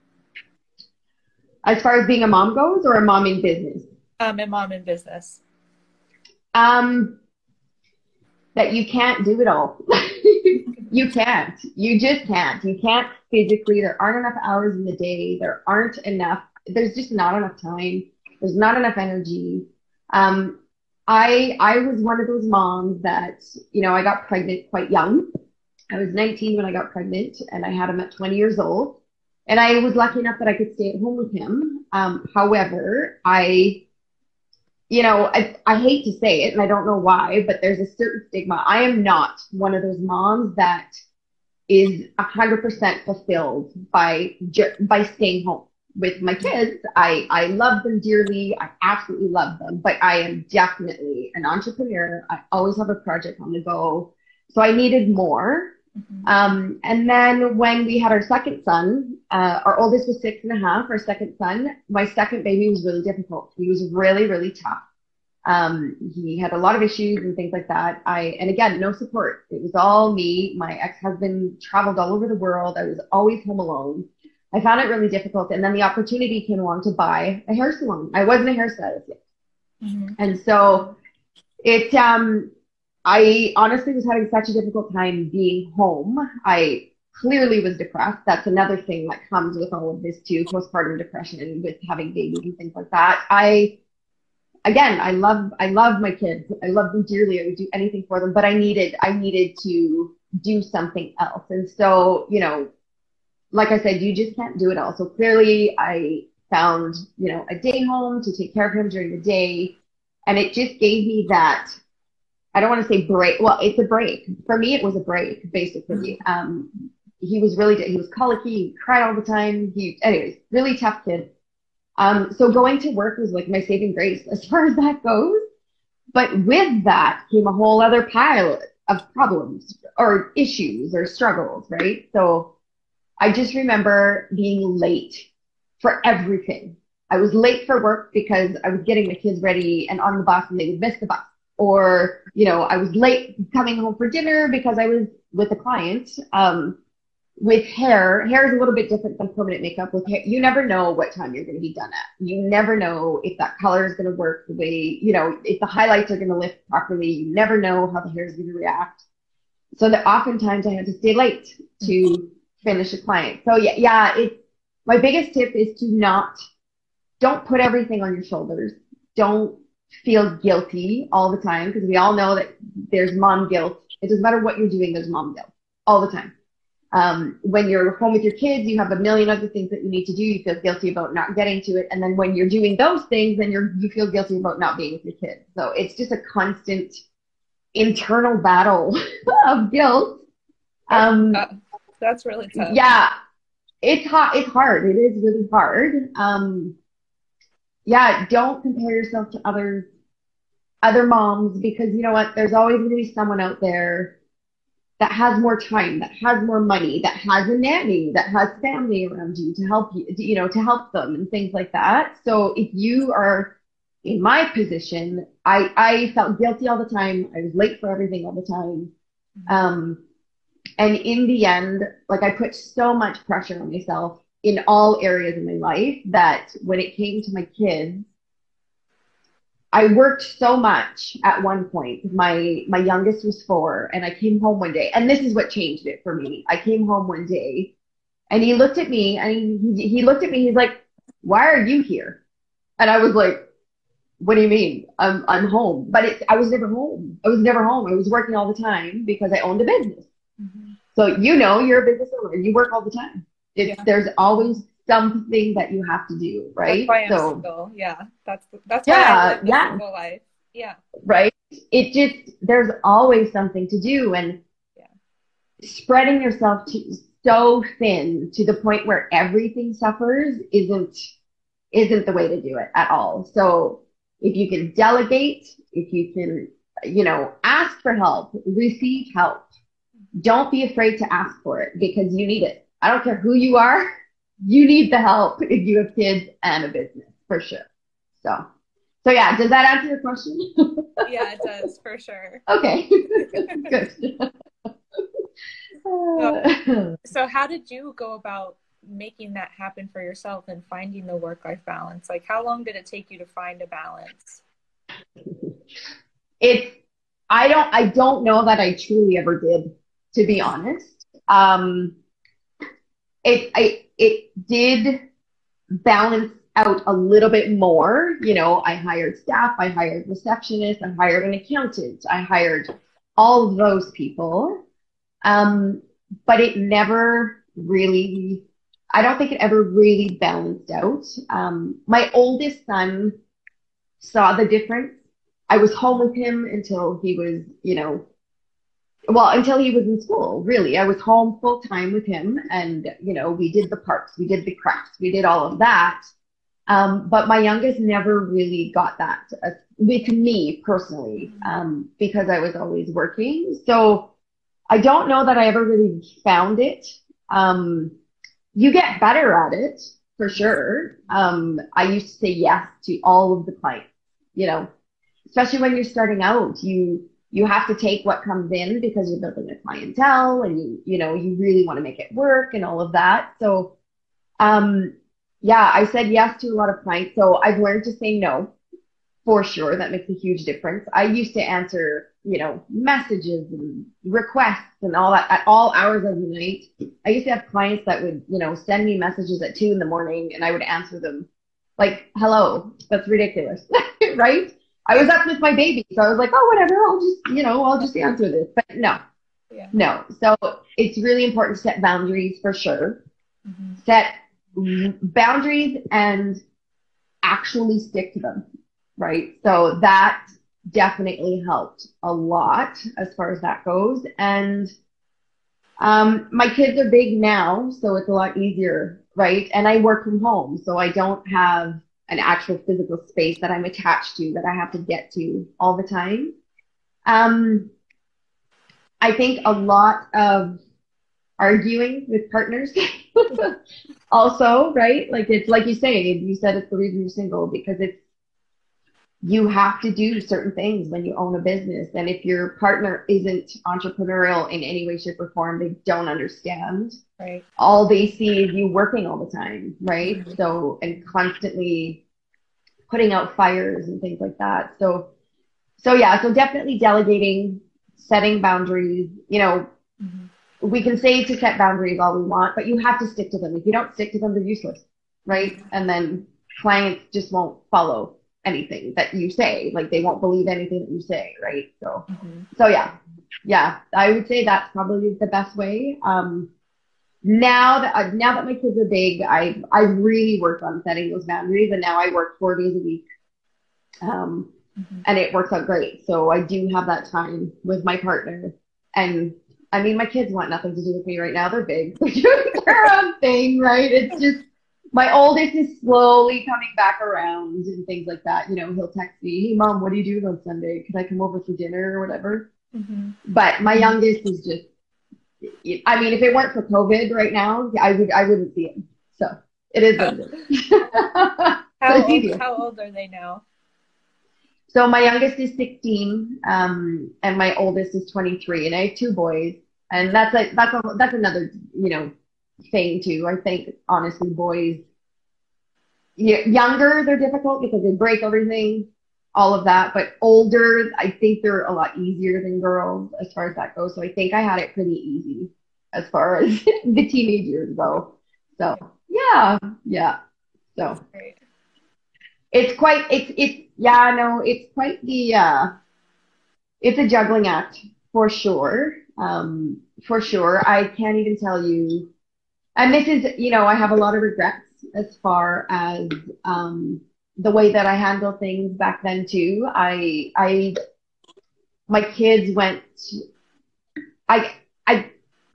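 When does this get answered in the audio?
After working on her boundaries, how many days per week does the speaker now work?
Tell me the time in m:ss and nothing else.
8:02.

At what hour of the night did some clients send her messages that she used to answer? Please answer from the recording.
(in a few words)
2 in the morning.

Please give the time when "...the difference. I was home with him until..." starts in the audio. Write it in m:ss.
5:34.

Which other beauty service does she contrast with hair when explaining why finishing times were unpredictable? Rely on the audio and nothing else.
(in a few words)
Permanent makeup.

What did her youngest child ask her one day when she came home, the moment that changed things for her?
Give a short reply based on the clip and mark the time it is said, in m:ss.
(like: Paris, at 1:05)
Why are you here?, at 4:01.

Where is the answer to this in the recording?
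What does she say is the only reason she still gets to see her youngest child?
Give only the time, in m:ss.
8:26.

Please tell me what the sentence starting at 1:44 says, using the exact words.
So clearly I found, you know, a day home to take care of him during the day.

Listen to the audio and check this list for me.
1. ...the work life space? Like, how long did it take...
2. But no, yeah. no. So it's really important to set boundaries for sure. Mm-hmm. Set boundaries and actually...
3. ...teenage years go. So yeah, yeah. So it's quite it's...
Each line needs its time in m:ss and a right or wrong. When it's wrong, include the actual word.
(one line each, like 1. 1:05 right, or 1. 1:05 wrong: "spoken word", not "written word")
1. 5:01 wrong: "balance", not "space"
2. 6:38 right
3. 8:57 right.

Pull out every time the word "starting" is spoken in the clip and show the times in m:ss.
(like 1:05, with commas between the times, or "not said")
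6:05.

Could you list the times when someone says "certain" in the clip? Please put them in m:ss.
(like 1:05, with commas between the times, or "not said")
0:37, 7:20.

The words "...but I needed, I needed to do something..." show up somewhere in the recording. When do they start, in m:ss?
1:38.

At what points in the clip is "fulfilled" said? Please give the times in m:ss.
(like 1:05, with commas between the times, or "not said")
0:43.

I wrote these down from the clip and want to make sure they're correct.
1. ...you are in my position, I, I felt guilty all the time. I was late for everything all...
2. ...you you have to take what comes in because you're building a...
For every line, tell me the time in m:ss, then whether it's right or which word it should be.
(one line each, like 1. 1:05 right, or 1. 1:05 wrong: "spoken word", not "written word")
1. 3:32 right
2. 6:06 right.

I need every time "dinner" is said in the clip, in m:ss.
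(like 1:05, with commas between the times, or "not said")
2:24, 8:21.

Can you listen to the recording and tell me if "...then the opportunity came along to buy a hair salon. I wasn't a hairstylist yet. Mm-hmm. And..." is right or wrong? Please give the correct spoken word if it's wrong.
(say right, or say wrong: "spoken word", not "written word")
right.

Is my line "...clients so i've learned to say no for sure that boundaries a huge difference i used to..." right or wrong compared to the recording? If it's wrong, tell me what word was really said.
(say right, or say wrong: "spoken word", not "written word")
wrong: "makes", not "boundaries".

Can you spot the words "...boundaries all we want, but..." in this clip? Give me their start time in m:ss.
7:41.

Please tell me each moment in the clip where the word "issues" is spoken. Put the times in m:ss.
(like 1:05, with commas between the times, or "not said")
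1:06, 2:10.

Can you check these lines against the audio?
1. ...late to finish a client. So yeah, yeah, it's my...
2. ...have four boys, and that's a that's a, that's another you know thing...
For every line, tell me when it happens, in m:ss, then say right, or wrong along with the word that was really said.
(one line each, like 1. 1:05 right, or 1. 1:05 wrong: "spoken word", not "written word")
1. 2:41 right
2. 8:38 wrong: "two", not "four".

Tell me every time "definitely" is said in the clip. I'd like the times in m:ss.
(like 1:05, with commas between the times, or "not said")
0:50, 6:50, 7:36.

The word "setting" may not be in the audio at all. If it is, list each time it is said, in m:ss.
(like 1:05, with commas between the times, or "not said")
7:37, 8:00.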